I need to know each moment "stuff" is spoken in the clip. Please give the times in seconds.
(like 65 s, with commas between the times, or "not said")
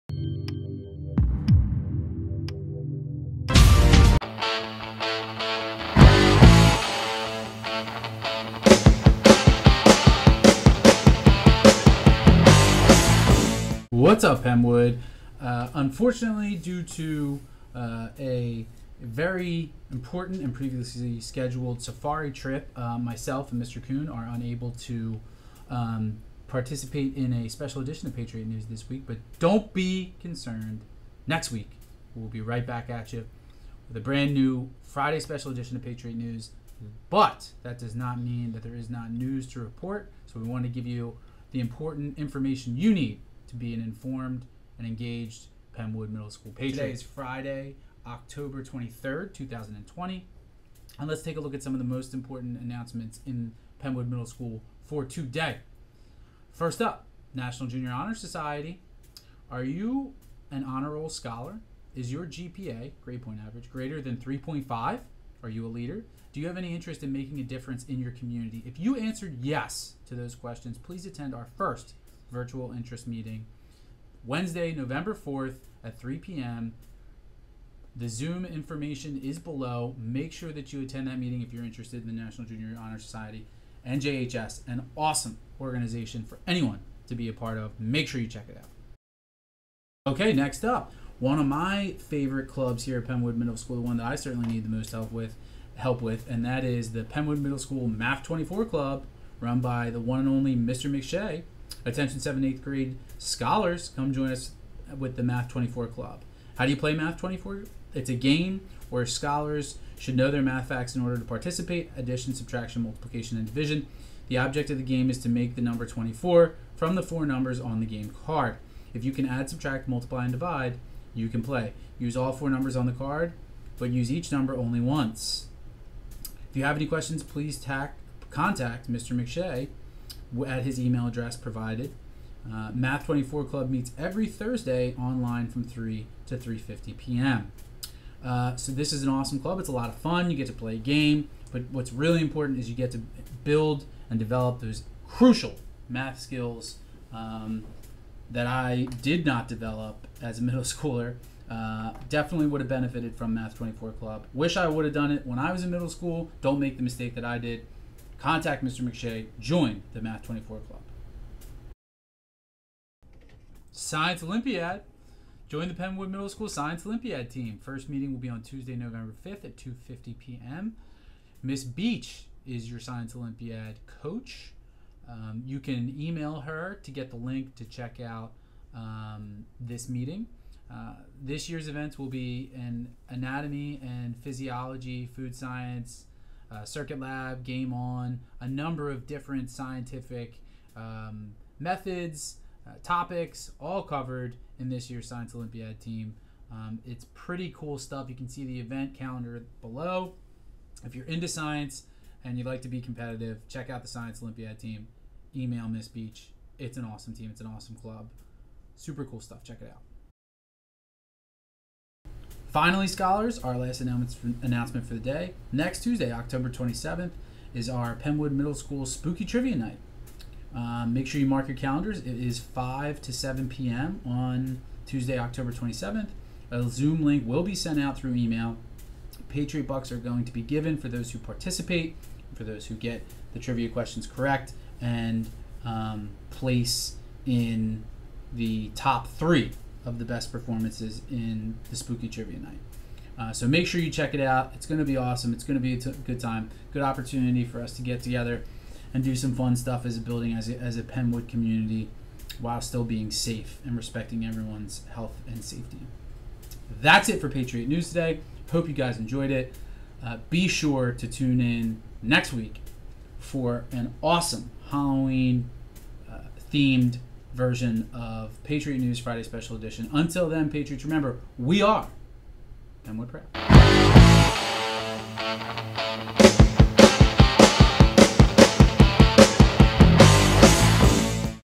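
197 s, 209 s, 249 s.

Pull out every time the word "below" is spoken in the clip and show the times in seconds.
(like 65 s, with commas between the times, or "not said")
79 s, 199 s.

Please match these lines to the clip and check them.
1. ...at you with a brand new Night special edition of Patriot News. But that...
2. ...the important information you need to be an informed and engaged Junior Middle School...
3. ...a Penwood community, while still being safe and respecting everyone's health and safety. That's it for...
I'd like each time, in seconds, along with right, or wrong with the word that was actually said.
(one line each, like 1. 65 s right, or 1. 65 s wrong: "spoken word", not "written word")
1. 32 s wrong: "Friday", not "Night"
2. 41 s wrong: "Penwood", not "Junior"
3. 250 s right.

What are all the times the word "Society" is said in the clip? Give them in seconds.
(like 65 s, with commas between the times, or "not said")
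58 s, 82 s.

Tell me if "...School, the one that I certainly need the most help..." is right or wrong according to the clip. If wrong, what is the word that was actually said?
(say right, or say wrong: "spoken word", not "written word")
right.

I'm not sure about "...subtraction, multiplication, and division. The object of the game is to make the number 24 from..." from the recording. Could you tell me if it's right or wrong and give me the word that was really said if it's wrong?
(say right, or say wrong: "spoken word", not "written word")
right.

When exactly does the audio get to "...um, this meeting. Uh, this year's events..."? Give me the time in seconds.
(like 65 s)
178 s.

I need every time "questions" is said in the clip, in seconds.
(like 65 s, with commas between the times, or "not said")
70 s, 126 s, 233 s.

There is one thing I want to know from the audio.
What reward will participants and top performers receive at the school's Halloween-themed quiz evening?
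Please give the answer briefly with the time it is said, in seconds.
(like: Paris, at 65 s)
Patriot Bucks, at 229 s.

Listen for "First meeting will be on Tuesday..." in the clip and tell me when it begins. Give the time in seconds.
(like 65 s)
167 s.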